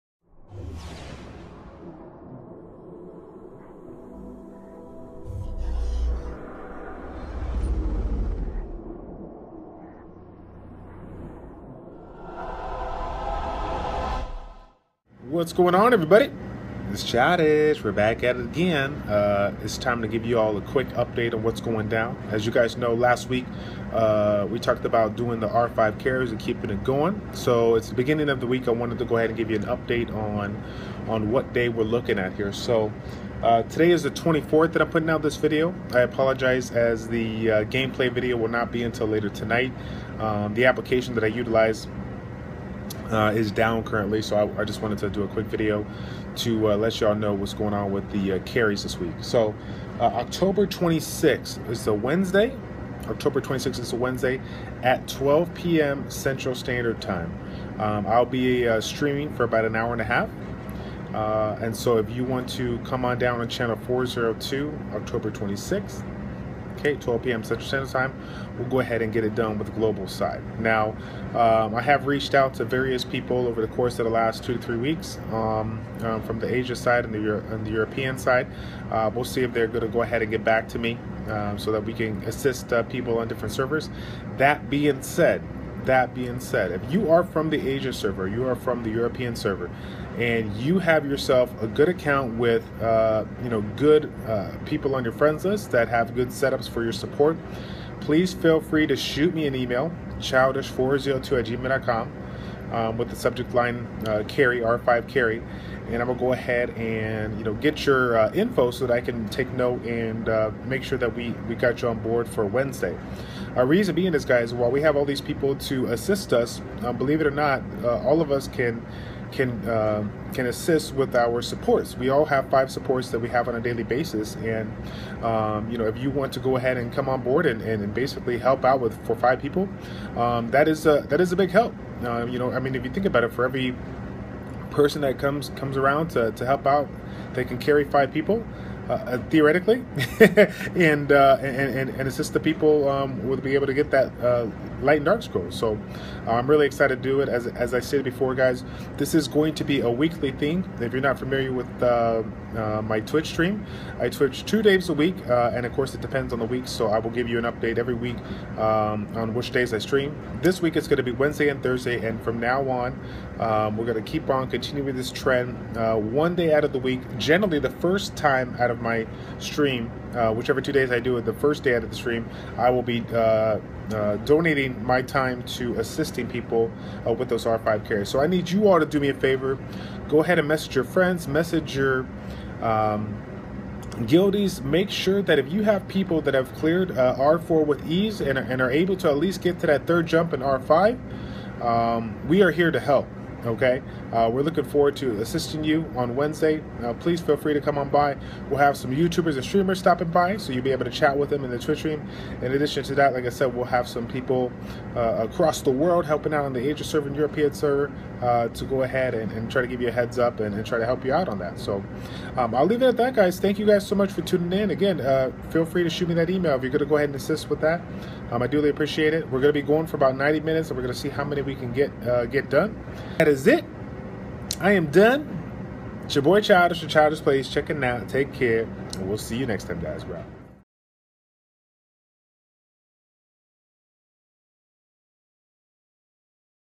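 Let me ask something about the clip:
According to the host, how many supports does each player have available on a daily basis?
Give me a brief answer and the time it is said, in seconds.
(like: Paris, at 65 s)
5, at 122 s.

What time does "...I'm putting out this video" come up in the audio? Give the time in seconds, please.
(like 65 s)
34 s.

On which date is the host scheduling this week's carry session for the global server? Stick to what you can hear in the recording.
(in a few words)
October 26th.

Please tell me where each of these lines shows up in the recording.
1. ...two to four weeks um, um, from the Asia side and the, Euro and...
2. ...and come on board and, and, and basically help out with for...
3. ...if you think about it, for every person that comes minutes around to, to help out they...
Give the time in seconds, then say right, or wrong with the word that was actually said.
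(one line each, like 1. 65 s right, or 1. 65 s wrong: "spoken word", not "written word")
1. 74 s wrong: "three", not "four"
2. 126 s right
3. 132 s wrong: "comes", not "minutes".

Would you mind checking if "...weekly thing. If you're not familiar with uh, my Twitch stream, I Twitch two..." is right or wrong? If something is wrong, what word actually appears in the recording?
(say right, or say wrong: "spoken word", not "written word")
right.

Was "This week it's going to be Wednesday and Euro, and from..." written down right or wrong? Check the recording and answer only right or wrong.
wrong.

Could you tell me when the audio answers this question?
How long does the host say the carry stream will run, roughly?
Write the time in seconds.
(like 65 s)
59 s.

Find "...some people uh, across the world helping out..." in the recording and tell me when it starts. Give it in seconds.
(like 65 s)
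203 s.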